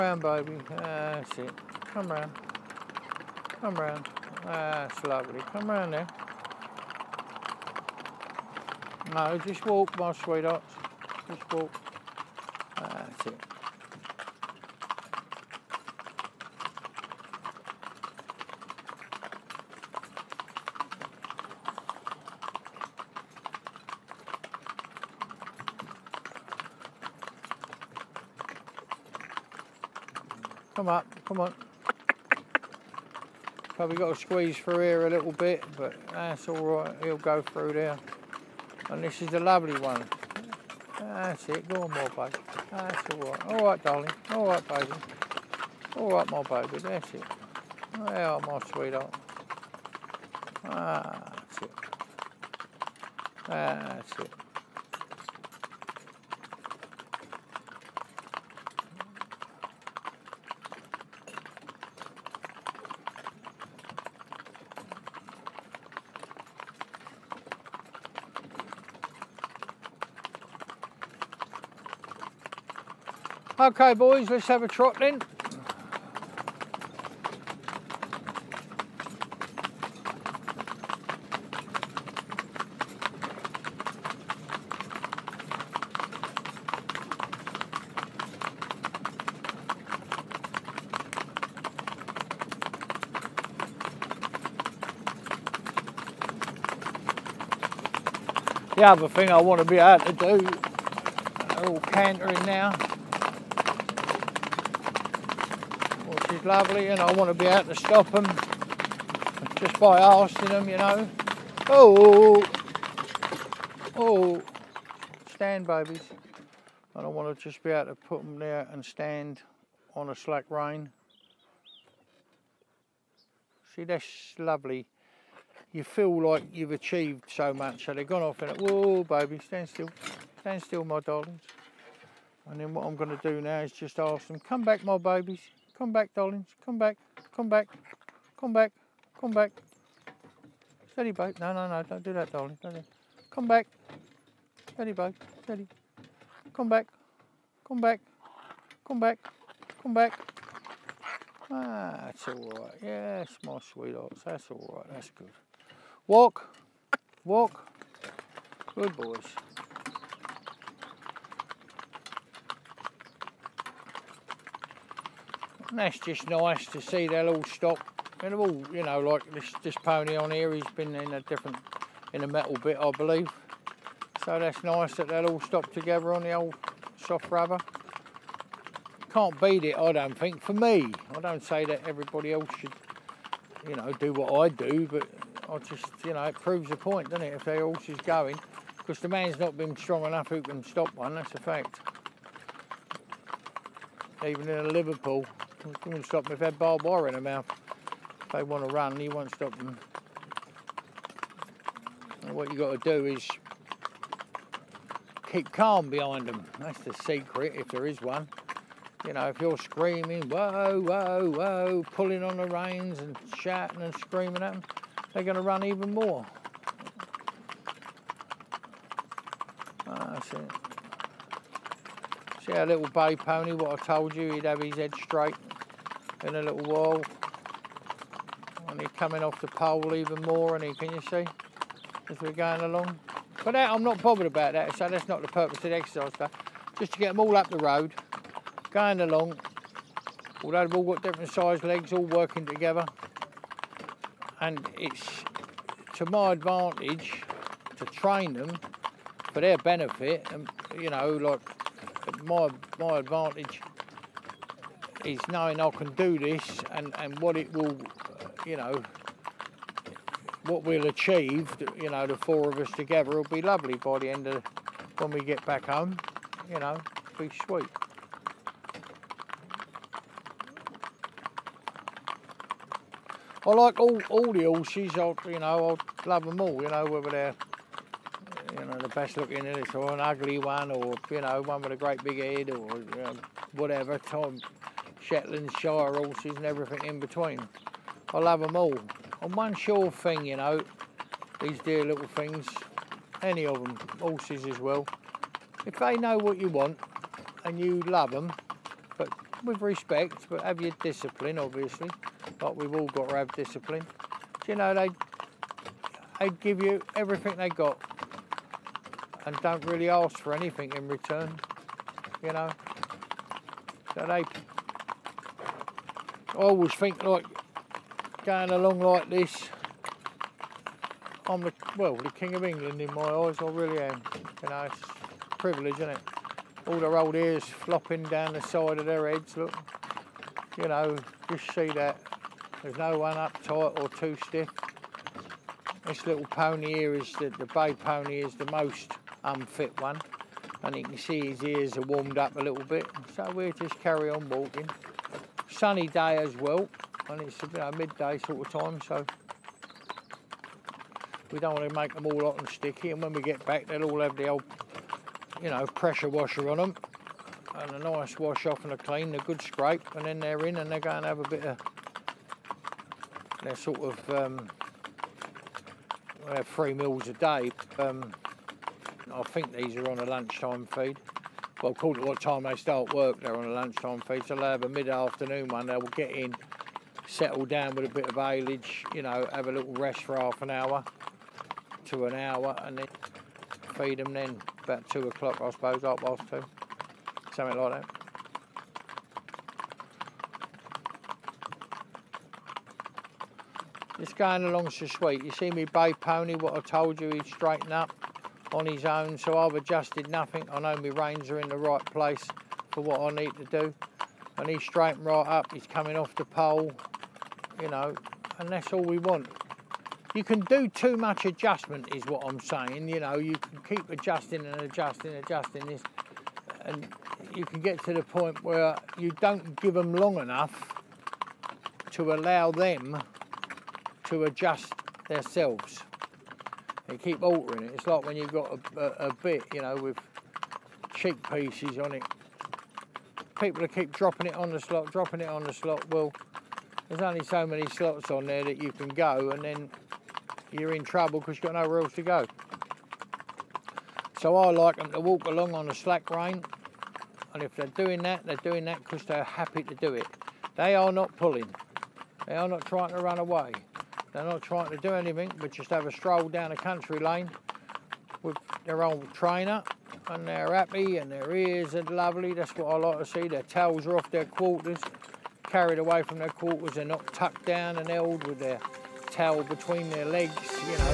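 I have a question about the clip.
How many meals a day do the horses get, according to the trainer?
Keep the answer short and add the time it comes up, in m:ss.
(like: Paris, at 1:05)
3, at 6:06.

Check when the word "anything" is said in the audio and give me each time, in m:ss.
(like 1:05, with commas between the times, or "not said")
5:10, 7:34.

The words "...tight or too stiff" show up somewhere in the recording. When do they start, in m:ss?
5:33.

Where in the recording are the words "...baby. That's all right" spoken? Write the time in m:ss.
0:42.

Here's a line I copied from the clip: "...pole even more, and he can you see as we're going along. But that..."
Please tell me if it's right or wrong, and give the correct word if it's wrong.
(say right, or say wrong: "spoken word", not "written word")
right.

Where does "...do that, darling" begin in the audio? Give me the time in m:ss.
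2:22.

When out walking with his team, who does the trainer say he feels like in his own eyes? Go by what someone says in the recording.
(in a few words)
King of England.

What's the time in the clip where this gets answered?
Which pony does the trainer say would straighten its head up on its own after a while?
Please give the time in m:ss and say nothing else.
3:42.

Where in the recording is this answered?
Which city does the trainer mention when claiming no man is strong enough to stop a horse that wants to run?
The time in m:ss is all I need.
3:14.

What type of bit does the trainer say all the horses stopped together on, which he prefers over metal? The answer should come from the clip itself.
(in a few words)
Soft rubber.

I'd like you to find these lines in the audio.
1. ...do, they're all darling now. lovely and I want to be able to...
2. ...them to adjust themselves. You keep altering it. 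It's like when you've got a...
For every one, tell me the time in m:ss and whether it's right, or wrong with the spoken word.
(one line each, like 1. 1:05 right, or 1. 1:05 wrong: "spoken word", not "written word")
1. 1:40 wrong: "cantering", not "darling"
2. 7:02 right.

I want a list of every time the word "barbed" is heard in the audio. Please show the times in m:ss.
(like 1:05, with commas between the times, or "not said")
3:16.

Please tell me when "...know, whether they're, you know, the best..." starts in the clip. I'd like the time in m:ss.
4:36.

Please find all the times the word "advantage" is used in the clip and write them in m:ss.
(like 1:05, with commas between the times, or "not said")
4:06, 4:12.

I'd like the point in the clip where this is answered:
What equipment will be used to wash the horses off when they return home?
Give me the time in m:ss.
5:55.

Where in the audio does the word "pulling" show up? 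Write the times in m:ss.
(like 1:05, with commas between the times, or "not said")
3:31, 7:31.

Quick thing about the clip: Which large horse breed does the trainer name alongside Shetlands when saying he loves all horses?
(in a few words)
Shire horses.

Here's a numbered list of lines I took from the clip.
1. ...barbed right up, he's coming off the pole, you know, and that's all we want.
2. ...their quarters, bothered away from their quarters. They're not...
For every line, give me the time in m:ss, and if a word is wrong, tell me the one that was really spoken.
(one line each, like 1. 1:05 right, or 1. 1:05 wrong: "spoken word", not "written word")
1. 6:44 wrong: "straightened", not "barbed"
2. 7:44 wrong: "carried", not "bothered".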